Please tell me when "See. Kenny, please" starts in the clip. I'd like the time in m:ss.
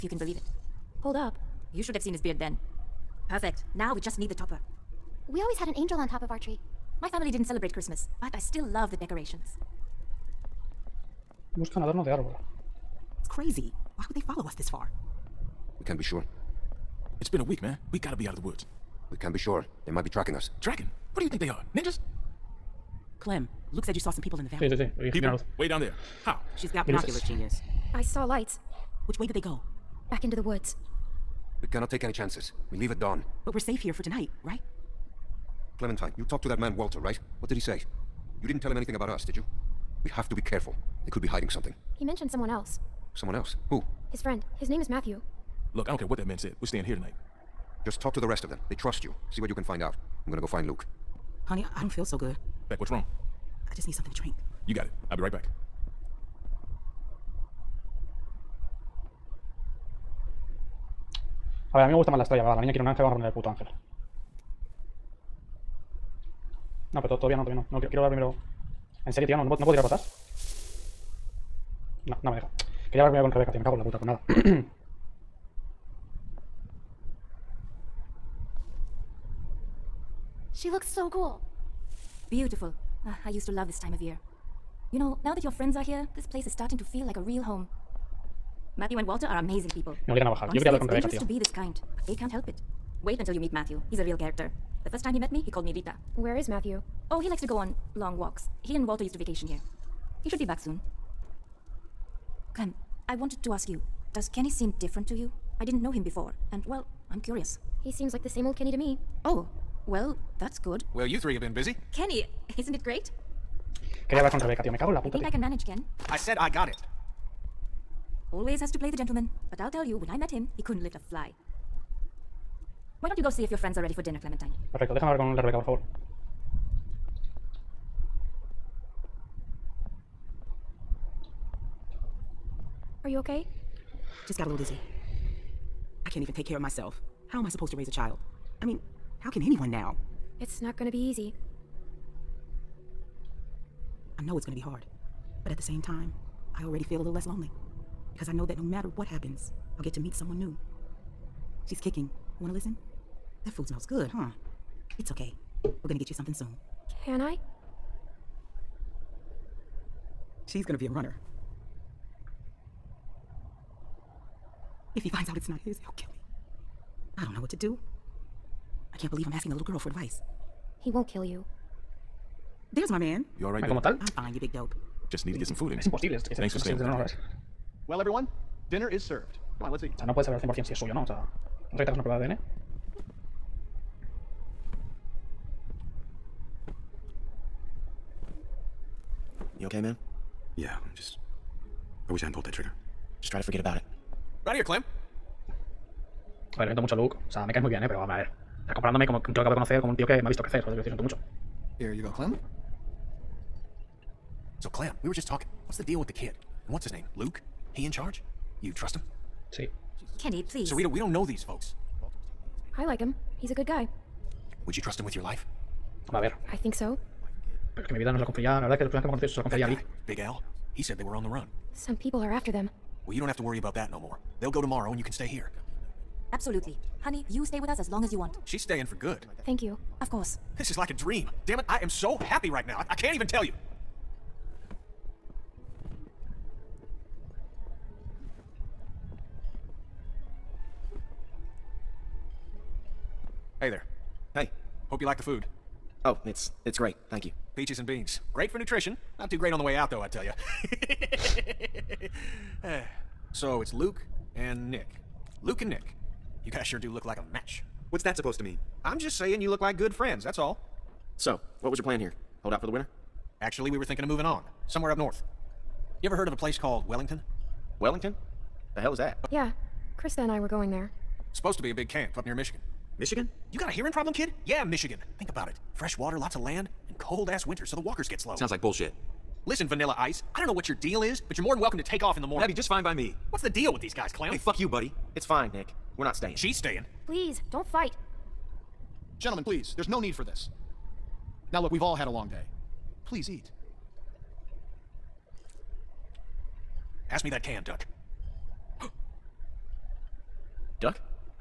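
3:29.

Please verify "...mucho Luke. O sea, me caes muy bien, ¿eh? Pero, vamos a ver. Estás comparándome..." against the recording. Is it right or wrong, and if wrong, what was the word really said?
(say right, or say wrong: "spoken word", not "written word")
right.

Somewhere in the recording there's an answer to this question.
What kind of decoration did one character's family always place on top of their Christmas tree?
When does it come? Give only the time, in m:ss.
0:05.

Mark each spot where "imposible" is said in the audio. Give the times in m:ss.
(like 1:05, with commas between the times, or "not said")
2:55.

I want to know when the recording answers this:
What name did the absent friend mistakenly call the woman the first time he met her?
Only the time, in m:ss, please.
1:35.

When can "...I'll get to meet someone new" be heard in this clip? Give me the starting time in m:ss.
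2:29.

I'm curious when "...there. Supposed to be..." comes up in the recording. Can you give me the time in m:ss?
4:30.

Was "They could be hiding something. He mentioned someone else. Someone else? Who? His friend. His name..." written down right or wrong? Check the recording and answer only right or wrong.
right.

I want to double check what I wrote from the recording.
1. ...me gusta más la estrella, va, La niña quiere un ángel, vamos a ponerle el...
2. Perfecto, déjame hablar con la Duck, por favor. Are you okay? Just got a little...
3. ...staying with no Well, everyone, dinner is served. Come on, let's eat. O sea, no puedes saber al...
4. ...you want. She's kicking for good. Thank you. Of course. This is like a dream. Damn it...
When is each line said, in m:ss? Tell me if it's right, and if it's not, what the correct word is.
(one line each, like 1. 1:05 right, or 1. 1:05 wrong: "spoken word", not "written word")
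1. 1:01 right
2. 2:04 wrong: "Rebeca", not "Duck"
3. 2:56 right
4. 3:48 wrong: "staying", not "kicking".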